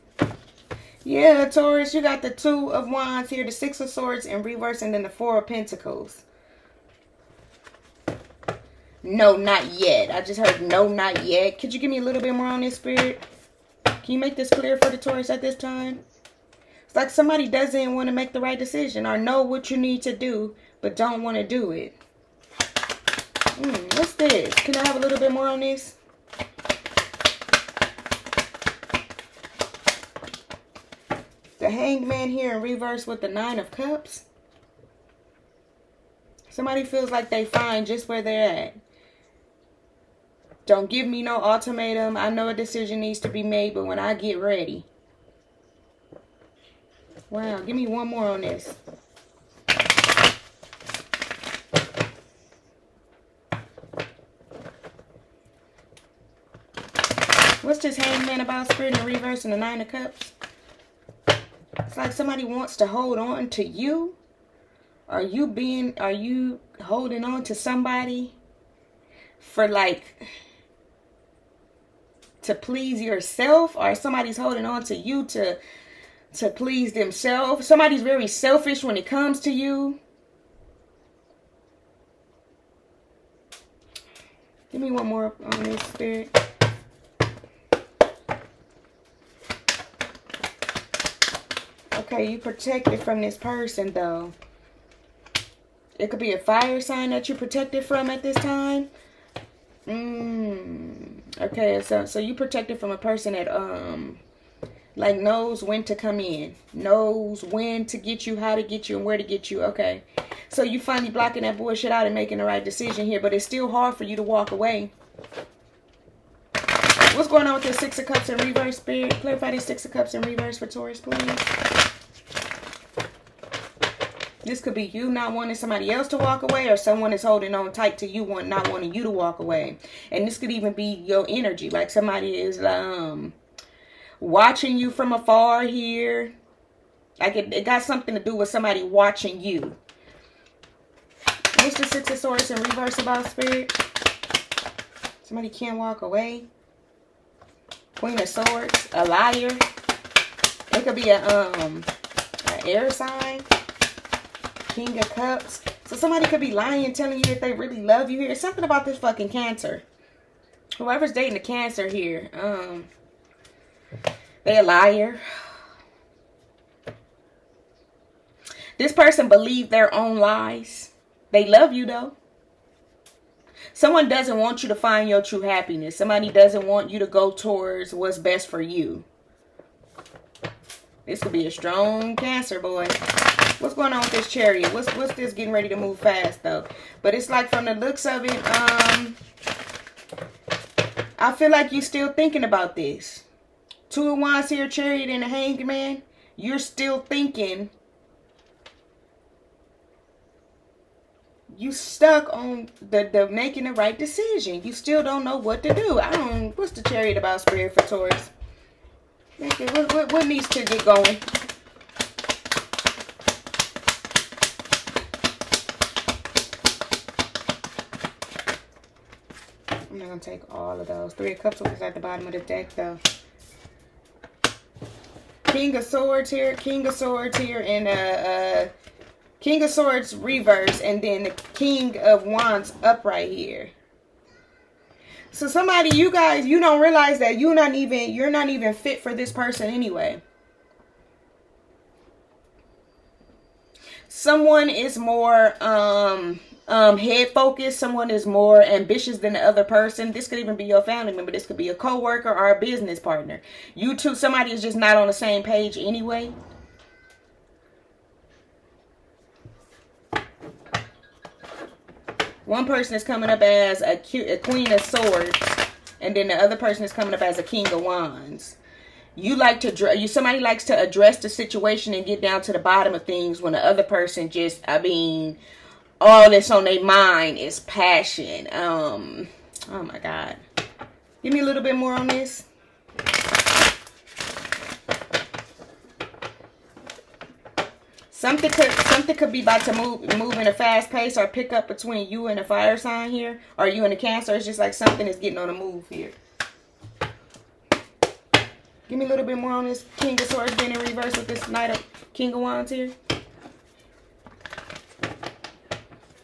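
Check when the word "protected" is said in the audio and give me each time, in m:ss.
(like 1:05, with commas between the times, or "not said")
1:32, 1:37, 1:42.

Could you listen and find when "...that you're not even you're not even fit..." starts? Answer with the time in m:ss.
3:57.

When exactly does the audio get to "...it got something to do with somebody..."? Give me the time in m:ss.
2:17.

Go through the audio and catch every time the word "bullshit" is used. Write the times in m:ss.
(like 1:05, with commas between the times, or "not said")
1:51.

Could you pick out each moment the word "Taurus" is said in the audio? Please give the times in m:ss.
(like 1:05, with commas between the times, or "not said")
0:01, 0:14, 2:00, 3:27.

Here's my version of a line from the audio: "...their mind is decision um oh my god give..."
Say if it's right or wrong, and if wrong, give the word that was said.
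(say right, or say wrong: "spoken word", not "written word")
wrong: "passion", not "decision".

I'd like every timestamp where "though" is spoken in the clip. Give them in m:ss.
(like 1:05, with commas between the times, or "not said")
1:33, 2:51, 3:06, 3:42.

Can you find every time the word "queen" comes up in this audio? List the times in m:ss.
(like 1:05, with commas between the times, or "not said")
2:27, 4:24.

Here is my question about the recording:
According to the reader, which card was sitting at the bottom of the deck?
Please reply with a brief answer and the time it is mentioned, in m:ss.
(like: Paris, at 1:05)
Three of Cups, at 3:41.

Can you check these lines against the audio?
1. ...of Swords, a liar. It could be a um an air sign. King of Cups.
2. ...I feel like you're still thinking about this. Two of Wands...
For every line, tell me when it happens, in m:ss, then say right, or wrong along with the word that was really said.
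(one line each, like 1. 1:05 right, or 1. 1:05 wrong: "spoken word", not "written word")
1. 2:28 right
2. 3:11 right.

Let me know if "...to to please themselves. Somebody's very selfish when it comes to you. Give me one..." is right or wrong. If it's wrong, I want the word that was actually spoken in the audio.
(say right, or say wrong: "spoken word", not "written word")
right.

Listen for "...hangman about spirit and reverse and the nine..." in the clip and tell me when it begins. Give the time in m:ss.
0:57.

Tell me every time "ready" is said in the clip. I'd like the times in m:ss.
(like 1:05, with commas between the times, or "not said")
0:44, 3:05.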